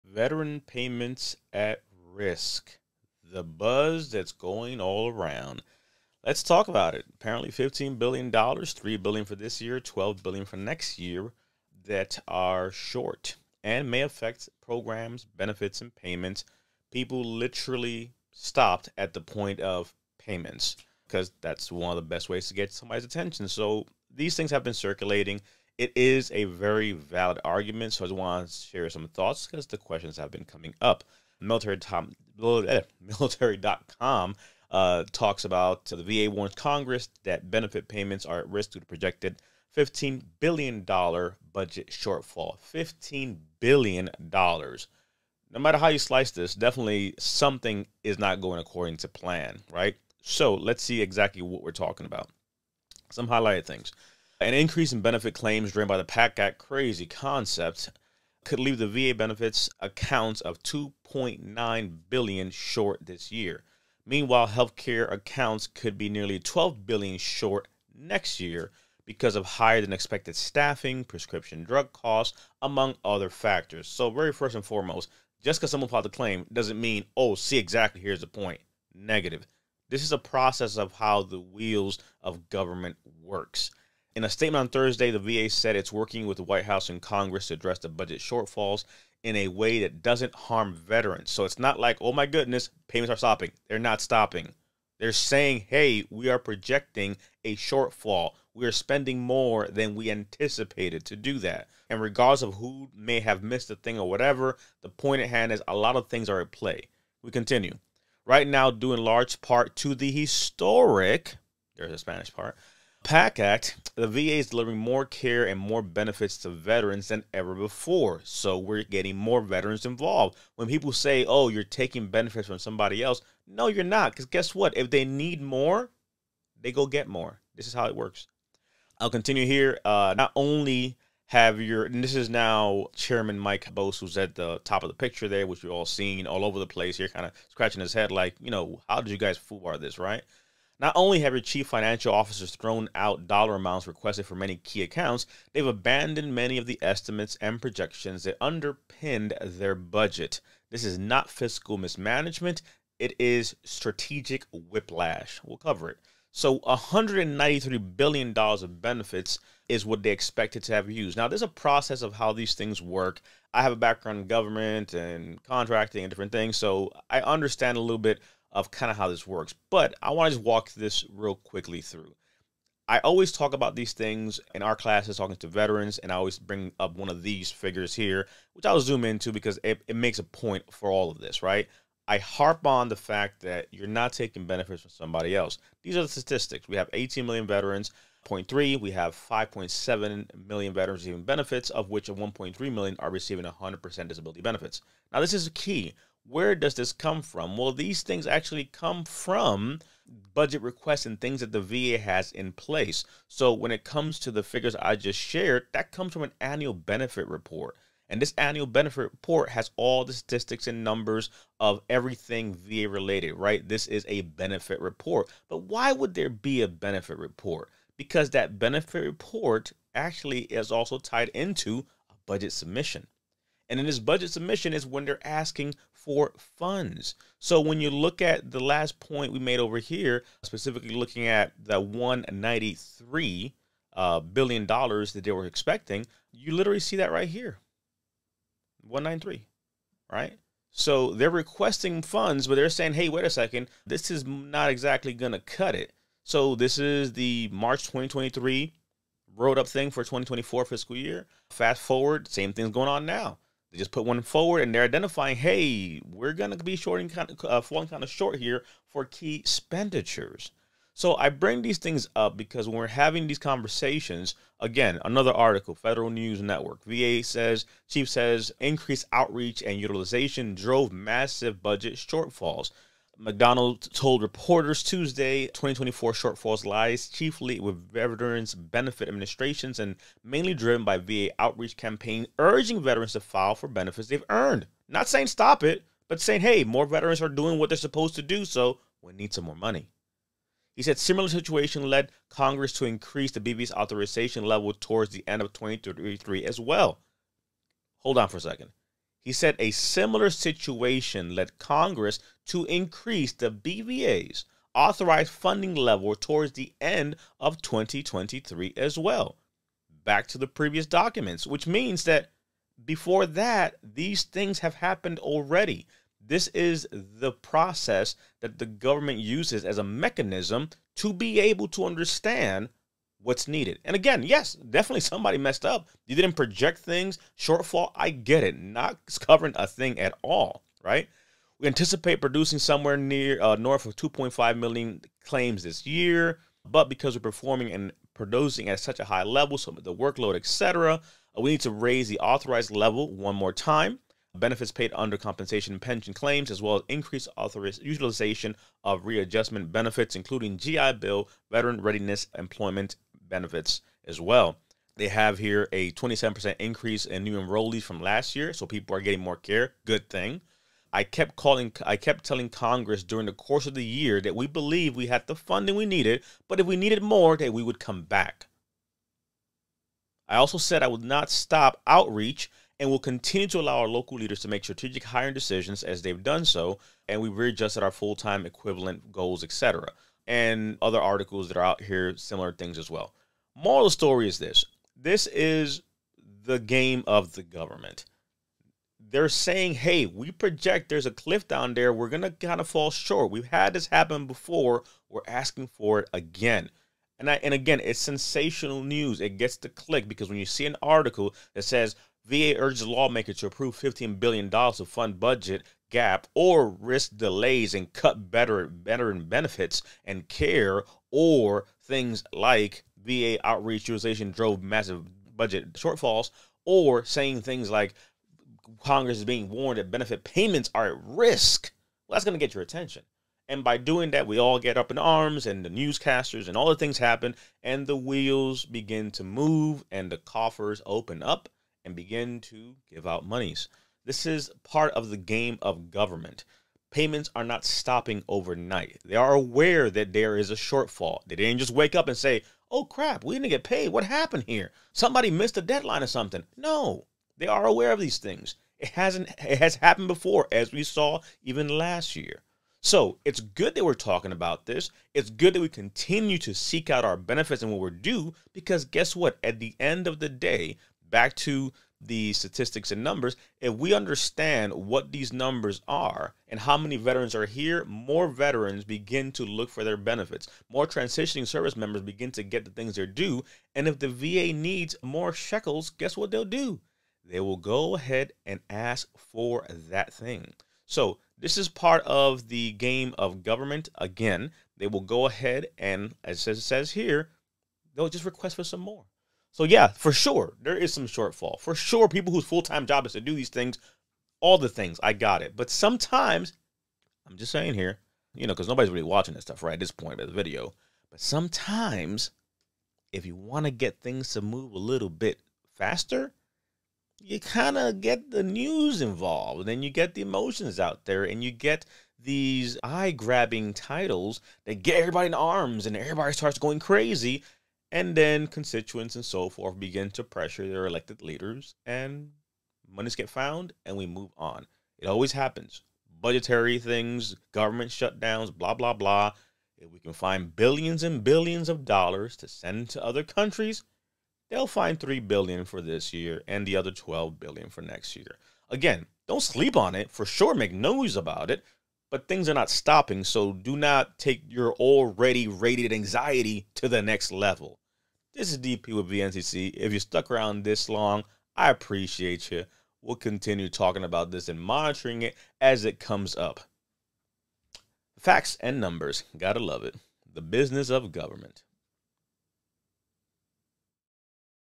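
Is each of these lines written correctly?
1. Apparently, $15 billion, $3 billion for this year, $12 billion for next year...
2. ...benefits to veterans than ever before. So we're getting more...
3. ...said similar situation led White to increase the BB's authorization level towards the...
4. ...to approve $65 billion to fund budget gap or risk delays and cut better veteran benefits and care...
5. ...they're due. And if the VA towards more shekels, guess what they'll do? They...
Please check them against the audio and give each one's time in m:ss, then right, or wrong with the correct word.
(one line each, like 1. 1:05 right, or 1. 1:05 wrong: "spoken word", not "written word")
1. 0:07 right
2. 1:55 right
3. 4:50 wrong: "Congress", not "White"
4. 6:43 wrong: "15", not "65"
5. 7:52 wrong: "needs", not "towards".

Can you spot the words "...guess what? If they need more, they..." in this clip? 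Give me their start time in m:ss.
2:04.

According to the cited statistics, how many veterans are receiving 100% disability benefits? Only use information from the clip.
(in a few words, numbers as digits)
1.3 million.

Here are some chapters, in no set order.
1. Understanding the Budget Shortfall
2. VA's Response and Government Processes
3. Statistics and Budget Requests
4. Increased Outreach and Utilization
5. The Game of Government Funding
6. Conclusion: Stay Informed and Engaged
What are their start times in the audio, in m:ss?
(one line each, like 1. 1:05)
1. 0:10
2. 1:24
3. 2:52
4. 4:20
5. 6:23
6. 7:32.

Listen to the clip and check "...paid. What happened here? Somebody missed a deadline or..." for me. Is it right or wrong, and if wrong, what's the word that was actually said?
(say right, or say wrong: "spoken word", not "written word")
right.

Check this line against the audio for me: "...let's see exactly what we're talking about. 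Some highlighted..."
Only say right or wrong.
right.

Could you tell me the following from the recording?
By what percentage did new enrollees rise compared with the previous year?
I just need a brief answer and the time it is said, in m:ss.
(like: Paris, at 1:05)
27%, at 5:55.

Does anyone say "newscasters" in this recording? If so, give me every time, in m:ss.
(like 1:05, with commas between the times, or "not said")
7:05.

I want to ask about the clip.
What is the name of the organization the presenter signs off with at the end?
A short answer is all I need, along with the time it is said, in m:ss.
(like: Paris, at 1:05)
VNCC, at 9:09.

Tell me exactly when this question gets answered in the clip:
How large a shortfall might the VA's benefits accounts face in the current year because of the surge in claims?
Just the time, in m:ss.
1:00.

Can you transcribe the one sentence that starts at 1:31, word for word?
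So it's not like, oh my goodness, payments are stopping.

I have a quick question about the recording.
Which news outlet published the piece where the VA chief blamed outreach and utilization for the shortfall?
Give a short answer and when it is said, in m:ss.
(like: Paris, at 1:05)
Federal News Network, at 4:25.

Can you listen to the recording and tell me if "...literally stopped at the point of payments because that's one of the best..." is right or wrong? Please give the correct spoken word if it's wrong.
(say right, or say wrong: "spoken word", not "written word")
right.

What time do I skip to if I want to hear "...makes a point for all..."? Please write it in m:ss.
2:59.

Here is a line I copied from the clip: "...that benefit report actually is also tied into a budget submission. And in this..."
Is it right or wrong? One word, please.
right.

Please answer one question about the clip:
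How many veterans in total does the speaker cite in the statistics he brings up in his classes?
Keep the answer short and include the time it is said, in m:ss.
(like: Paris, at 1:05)
18 million, at 3:06.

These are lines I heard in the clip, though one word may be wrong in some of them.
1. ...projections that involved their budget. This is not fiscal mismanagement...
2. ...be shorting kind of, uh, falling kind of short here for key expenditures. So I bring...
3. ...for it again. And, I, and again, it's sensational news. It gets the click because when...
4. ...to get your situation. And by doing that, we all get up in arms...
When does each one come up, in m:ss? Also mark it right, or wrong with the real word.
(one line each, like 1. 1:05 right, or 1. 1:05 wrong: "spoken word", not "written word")
1. 2:27 wrong: "underpinned", not "involved"
2. 4:16 right
3. 6:35 right
4. 7:02 wrong: "attention", not "situation".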